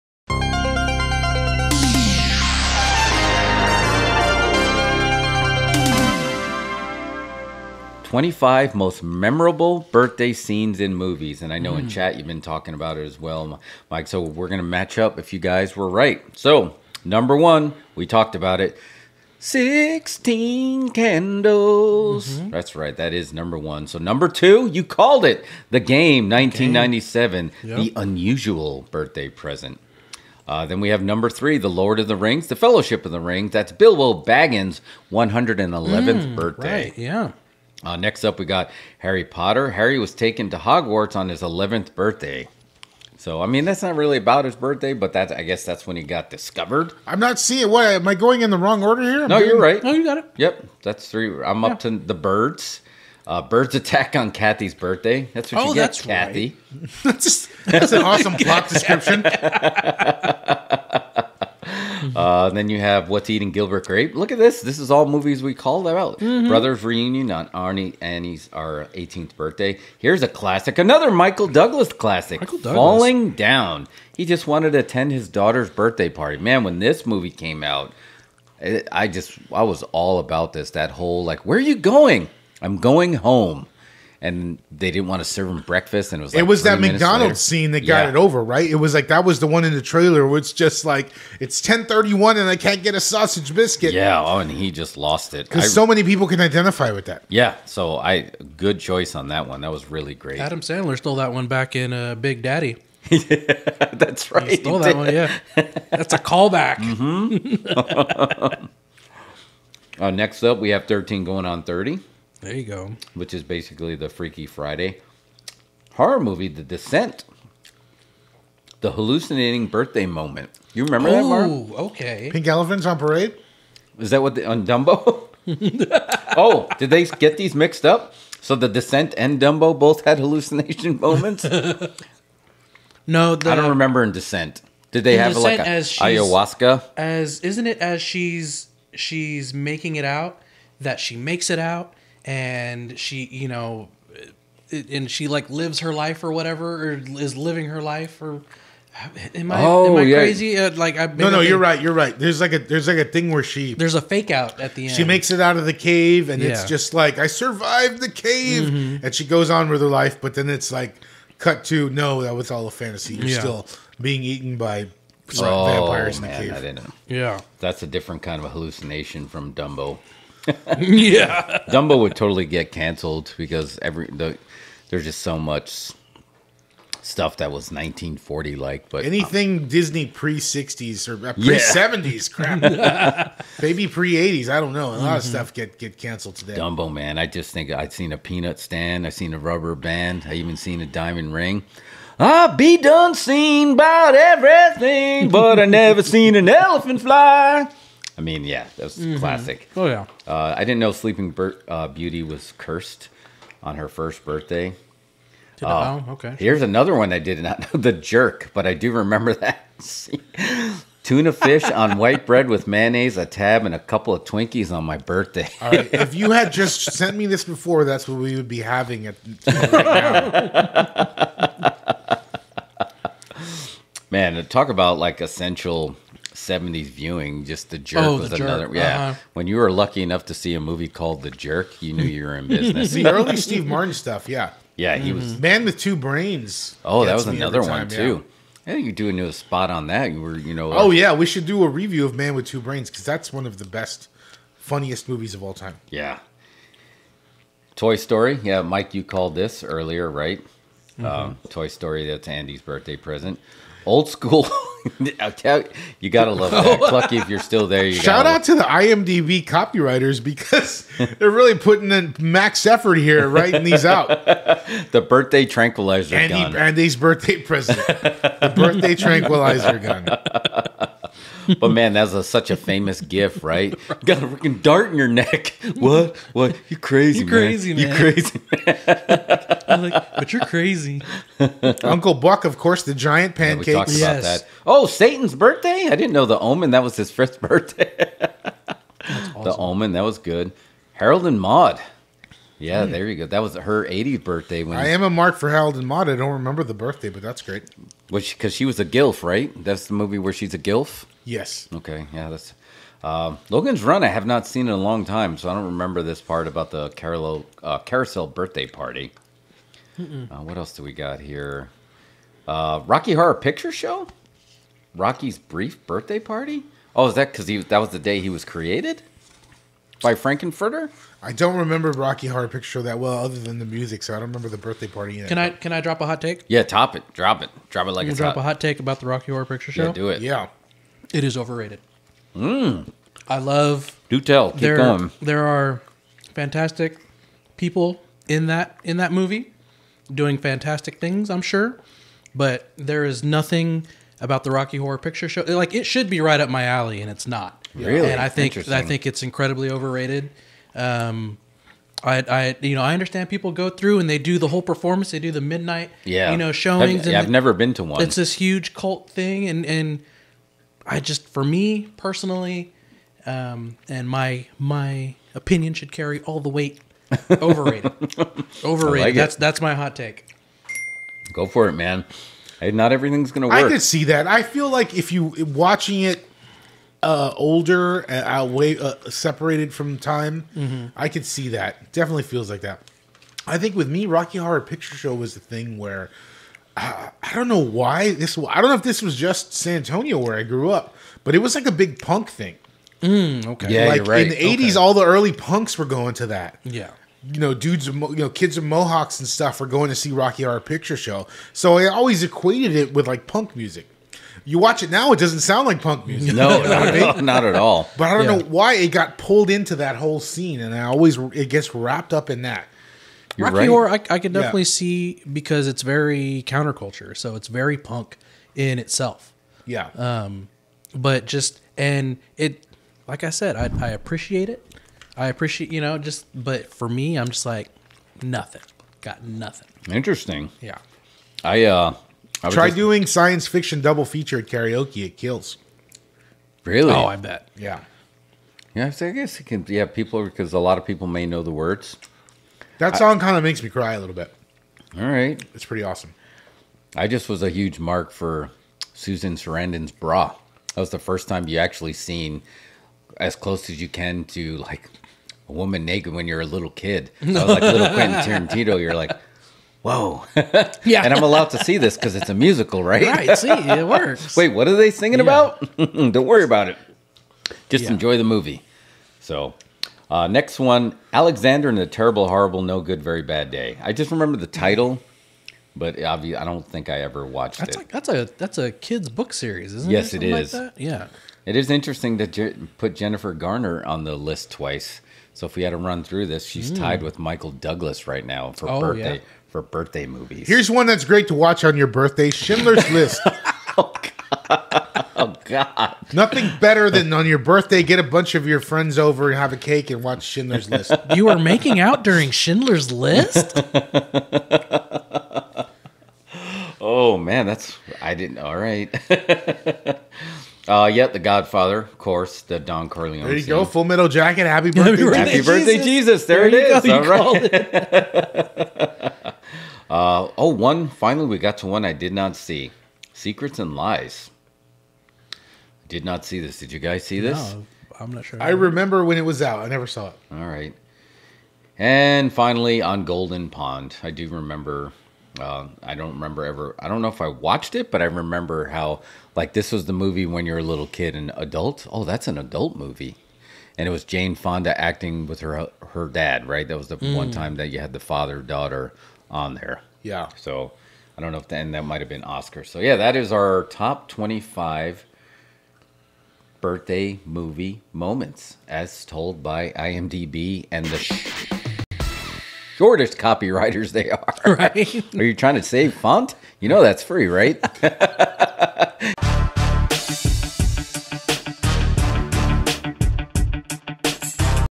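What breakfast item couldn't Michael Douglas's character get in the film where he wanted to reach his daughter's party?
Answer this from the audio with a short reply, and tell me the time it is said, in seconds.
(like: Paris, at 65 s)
Sausage biscuit, at 92 s.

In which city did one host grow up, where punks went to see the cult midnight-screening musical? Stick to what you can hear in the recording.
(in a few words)
San Antonio.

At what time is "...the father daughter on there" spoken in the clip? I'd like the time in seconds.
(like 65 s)
547 s.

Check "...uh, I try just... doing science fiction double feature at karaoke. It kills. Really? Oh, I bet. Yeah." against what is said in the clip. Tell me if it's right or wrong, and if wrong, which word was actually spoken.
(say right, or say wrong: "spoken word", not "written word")
right.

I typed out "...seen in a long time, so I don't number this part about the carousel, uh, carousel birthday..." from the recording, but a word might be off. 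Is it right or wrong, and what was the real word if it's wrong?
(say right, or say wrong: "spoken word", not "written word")
wrong: "remember", not "number".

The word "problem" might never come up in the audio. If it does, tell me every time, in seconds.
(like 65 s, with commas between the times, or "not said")
not said.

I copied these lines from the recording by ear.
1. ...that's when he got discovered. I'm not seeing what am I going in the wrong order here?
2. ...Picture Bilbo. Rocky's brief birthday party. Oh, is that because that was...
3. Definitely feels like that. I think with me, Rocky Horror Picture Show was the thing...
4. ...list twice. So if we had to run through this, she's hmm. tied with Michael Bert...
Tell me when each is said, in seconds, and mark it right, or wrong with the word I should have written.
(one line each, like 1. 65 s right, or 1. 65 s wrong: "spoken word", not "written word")
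1. 45 s right
2. 313 s wrong: "Show", not "Bilbo"
3. 381 s right
4. 484 s wrong: "Douglas", not "Bert".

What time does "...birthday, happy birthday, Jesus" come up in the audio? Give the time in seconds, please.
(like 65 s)
514 s.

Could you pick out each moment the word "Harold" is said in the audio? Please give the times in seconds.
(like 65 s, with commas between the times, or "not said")
290 s, 295 s.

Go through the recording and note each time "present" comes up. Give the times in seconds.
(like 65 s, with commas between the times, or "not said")
29 s, 252 s, 267 s.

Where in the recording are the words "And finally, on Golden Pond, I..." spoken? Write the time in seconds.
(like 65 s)
531 s.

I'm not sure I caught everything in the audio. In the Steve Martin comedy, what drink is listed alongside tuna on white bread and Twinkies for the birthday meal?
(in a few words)
Tab.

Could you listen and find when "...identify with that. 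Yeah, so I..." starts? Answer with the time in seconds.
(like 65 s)
96 s.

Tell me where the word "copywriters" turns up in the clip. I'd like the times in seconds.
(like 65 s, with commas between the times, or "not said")
259 s, 563 s.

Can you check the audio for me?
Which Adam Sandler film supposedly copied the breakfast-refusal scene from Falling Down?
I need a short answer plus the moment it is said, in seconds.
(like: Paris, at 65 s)
Big Daddy, at 102 s.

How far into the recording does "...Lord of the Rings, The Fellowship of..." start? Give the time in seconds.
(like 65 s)
31 s.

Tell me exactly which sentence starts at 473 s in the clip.
I just remember the title, but obviously I don't think I ever watched That's it.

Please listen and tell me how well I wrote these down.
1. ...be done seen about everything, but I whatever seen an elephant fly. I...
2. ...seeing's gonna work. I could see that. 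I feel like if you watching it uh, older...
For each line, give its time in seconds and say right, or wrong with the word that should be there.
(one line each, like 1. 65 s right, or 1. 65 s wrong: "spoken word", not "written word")
1. 192 s wrong: "never", not "whatever"
2. 372 s wrong: "everything", not "seeing".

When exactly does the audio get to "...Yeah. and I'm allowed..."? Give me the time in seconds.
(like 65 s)
460 s.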